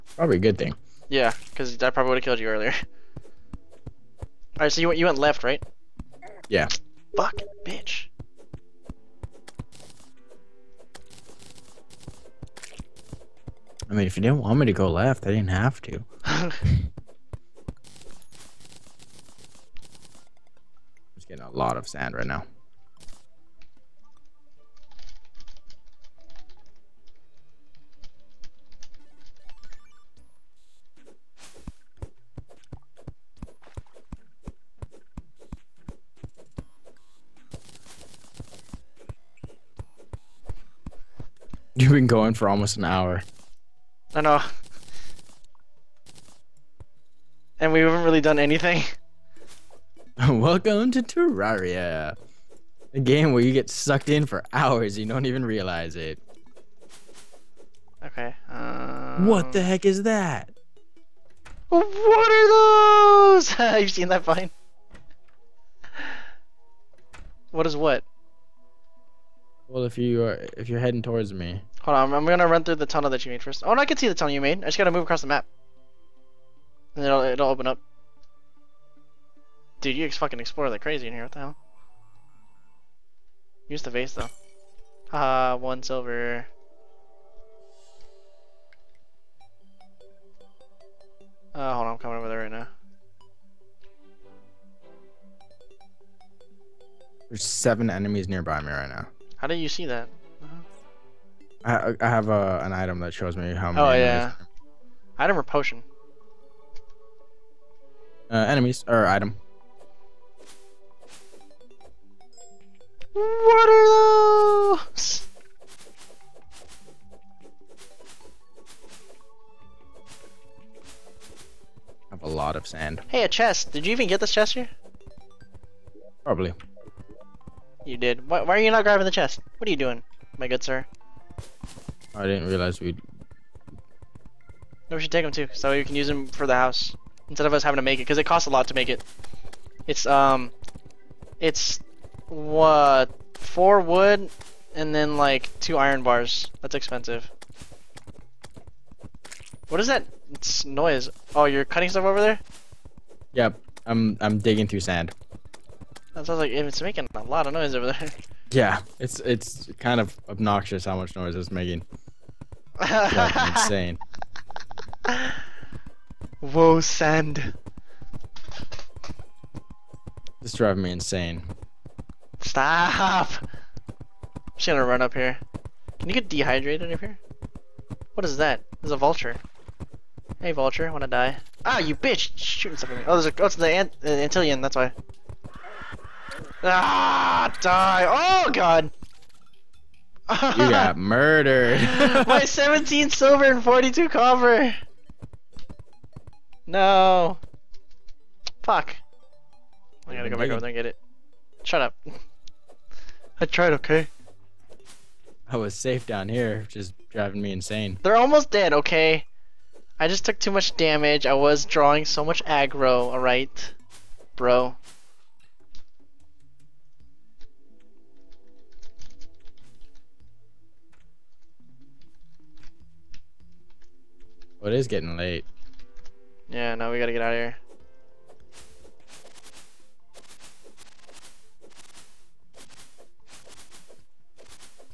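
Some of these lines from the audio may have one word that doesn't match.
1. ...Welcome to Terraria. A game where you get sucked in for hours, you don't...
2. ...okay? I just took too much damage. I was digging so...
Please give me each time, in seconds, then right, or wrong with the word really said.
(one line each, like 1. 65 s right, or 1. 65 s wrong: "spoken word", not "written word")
1. 50 s right
2. 208 s wrong: "drawing", not "digging".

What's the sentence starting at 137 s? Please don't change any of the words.
Instead of us having to make it, because it costs a lot to make it.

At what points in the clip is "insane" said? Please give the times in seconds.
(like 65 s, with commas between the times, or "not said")
163 s, 170 s, 207 s.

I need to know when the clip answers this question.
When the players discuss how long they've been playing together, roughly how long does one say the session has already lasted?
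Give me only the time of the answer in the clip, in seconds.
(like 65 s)
42 s.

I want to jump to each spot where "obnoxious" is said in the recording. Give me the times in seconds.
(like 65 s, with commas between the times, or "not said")
160 s.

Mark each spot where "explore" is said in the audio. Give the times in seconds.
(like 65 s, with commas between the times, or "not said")
80 s.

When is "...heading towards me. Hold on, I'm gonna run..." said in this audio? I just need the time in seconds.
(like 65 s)
70 s.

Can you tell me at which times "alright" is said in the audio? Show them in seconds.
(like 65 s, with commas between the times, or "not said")
213 s.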